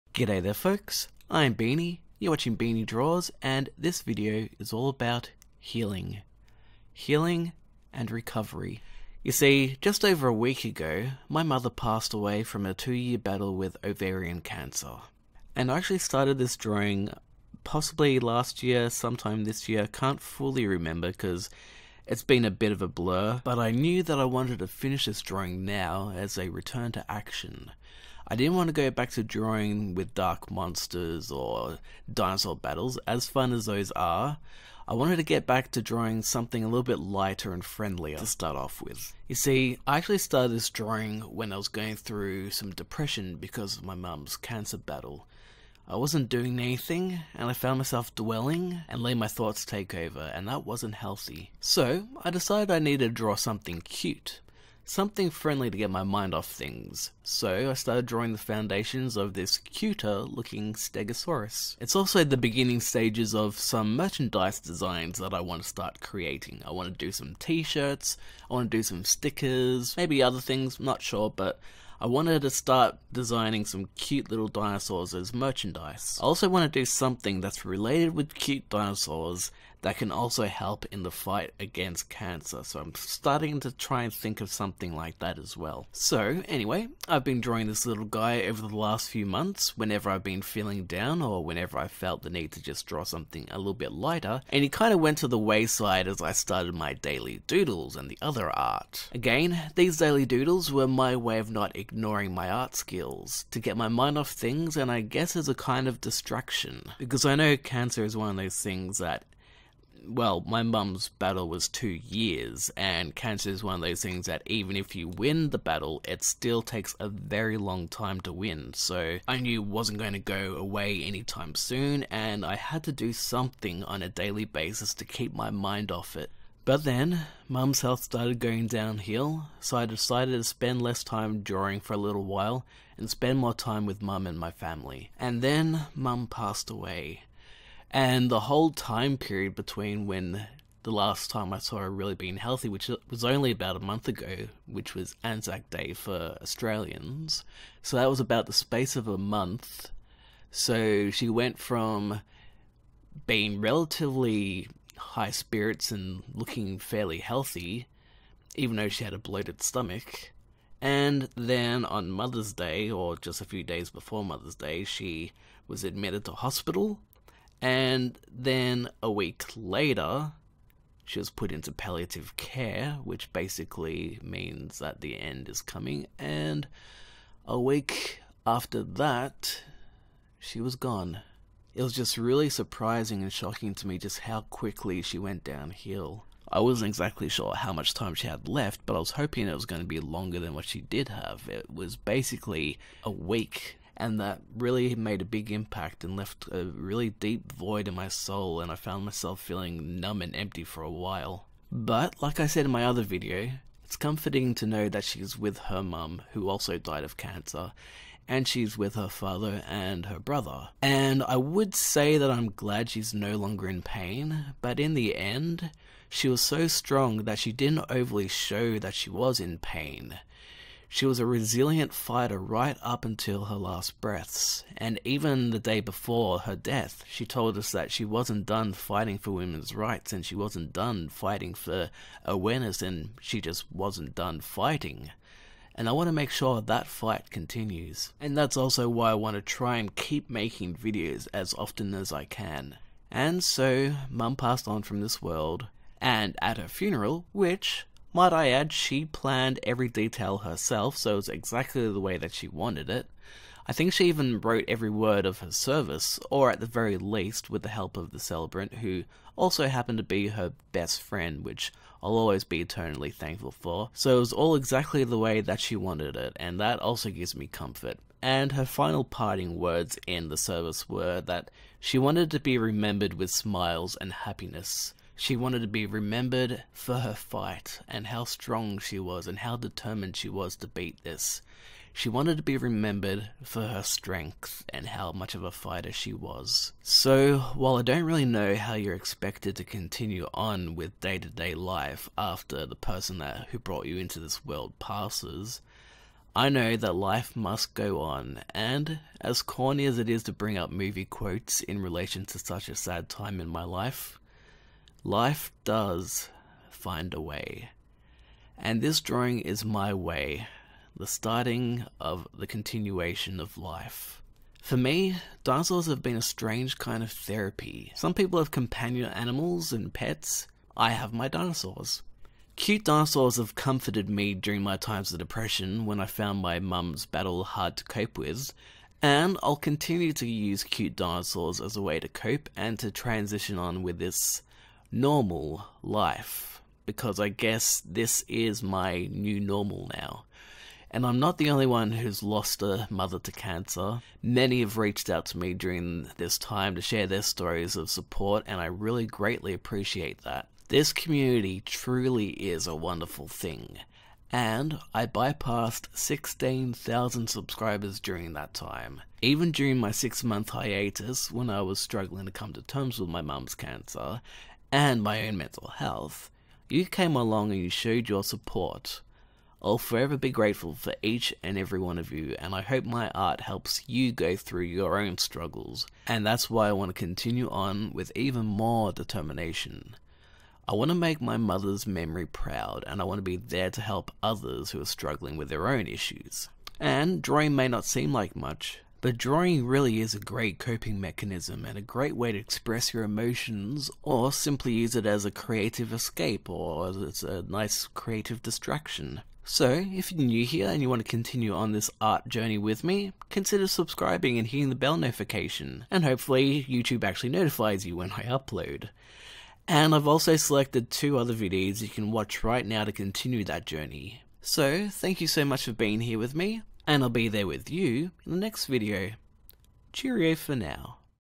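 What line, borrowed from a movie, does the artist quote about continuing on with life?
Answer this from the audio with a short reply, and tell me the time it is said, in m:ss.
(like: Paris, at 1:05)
Life does find a way, at 5:05.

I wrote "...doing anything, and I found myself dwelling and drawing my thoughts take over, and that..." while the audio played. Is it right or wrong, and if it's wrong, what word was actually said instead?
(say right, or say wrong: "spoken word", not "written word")
wrong: "letting", not "drawing".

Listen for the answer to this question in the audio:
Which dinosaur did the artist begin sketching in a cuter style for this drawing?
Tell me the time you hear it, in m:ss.
1:00.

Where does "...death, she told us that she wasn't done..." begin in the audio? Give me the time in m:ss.
3:46.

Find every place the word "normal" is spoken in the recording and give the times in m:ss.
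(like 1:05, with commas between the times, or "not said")
5:34, 5:39.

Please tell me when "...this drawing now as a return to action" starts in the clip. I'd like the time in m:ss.
0:25.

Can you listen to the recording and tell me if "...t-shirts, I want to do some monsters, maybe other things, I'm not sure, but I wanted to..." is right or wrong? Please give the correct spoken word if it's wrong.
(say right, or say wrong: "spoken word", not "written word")
wrong: "stickers", not "monsters".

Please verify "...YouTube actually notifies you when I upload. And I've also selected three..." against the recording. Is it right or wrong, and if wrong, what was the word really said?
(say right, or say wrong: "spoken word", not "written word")
wrong: "two", not "three".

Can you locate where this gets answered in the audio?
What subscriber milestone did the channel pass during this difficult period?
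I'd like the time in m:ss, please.
5:55.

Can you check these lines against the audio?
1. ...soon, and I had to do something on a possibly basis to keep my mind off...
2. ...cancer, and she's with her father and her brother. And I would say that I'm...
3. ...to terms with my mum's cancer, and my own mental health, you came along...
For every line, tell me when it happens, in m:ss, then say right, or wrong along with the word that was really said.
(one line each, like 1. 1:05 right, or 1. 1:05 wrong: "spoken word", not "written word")
1. 2:01 wrong: "daily", not "possibly"
2. 3:27 right
3. 6:02 right.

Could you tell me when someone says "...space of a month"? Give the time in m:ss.
2:28.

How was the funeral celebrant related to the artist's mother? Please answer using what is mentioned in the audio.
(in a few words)
her best friend.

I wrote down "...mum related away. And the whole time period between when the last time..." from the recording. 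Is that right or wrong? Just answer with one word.
wrong.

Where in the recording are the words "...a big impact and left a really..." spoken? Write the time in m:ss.
3:15.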